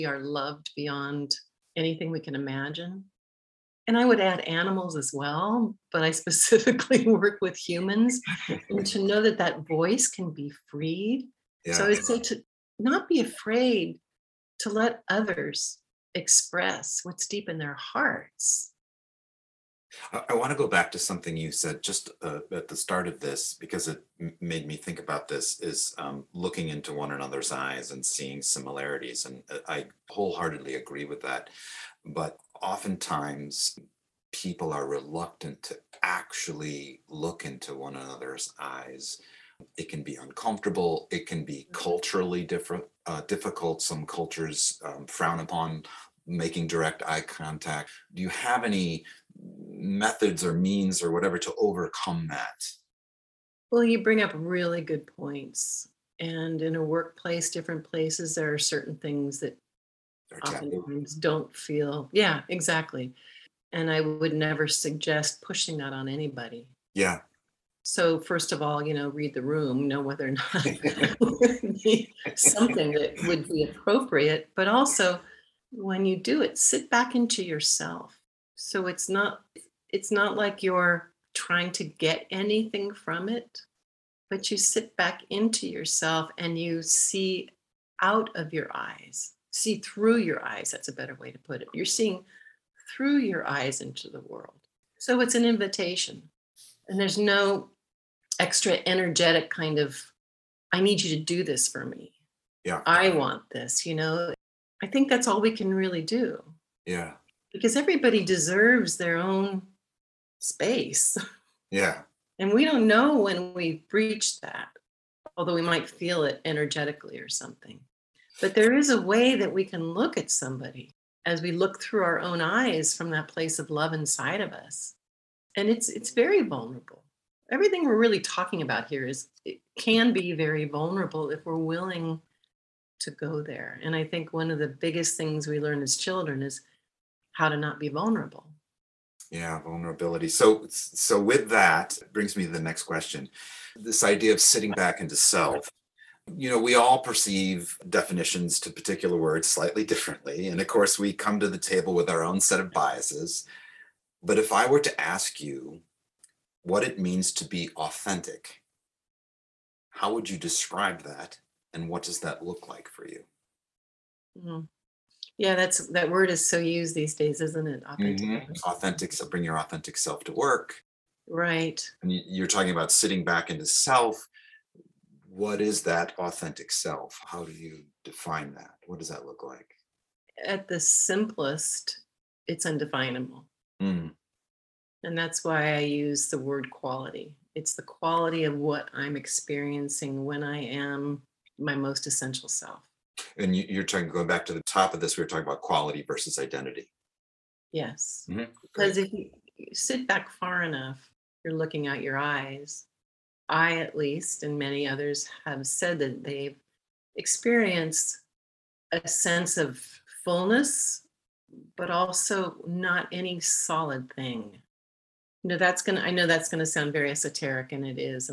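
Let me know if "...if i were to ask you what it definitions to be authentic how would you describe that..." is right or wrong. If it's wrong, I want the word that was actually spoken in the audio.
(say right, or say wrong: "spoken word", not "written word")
wrong: "means", not "definitions".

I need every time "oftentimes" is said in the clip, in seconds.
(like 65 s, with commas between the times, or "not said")
32 s, 60 s.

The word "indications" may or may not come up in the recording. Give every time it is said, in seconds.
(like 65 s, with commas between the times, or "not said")
not said.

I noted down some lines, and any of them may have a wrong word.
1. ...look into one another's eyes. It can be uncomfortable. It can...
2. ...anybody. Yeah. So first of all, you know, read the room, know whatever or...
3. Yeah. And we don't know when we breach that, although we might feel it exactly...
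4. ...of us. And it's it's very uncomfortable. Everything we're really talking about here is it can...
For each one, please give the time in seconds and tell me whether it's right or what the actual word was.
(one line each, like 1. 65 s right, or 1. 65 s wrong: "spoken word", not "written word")
1. 37 s right
2. 66 s wrong: "whether", not "whatever"
3. 111 s wrong: "energetically", not "exactly"
4. 124 s wrong: "vulnerable", not "uncomfortable".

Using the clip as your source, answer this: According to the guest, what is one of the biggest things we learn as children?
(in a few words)
how to not be vulnerable.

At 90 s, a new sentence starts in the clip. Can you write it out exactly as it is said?
That's a better way to put it.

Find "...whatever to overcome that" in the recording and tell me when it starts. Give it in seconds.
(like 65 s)
51 s.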